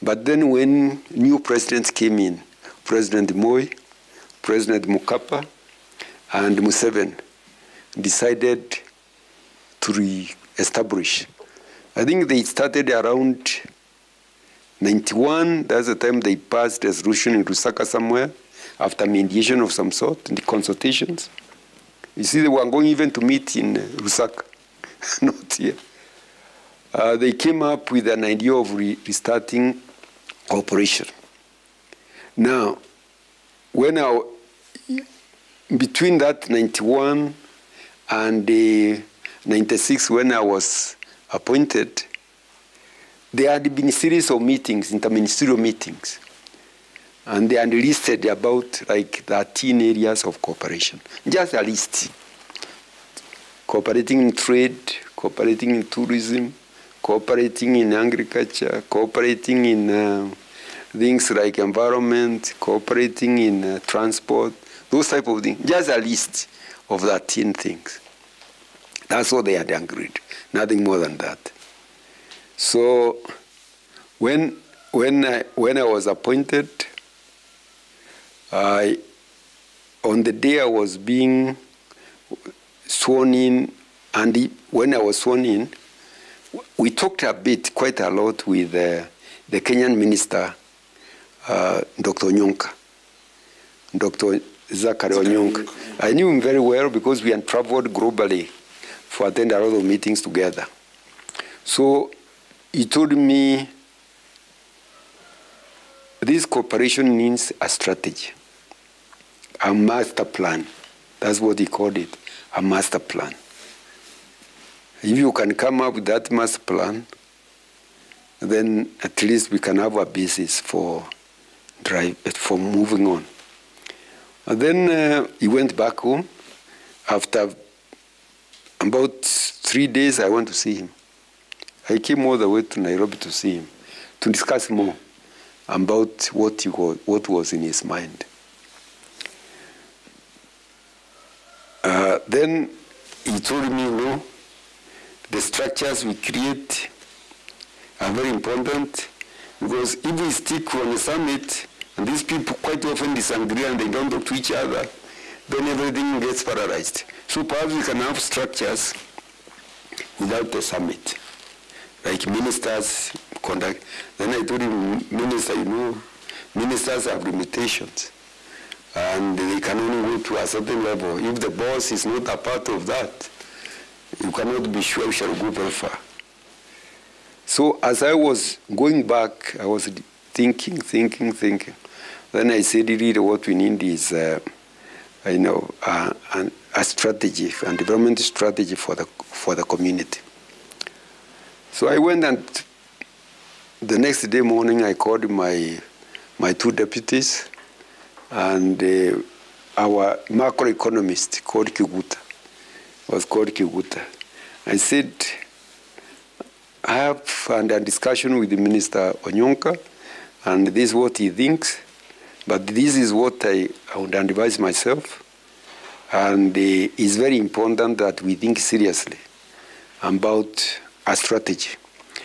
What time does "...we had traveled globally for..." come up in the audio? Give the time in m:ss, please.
1:37.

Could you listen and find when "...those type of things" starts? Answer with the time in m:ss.
1:04.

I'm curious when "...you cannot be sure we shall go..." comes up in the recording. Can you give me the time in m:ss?
2:54.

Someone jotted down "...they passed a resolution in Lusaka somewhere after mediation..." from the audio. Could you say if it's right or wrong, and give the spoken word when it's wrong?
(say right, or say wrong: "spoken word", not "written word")
right.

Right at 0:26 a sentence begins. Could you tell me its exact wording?
Uh, they came up with an idea of re restarting cooperation.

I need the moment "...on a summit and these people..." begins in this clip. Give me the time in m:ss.
2:30.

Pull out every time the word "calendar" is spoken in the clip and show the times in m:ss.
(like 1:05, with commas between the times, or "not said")
not said.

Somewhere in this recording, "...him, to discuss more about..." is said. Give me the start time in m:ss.
2:13.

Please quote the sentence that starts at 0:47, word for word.
and they listed about like 13 areas of cooperation.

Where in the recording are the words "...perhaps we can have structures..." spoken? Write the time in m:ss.
2:37.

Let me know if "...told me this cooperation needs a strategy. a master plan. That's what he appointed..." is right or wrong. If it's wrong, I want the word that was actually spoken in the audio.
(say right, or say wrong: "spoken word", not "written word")
wrong: "called", not "appointed".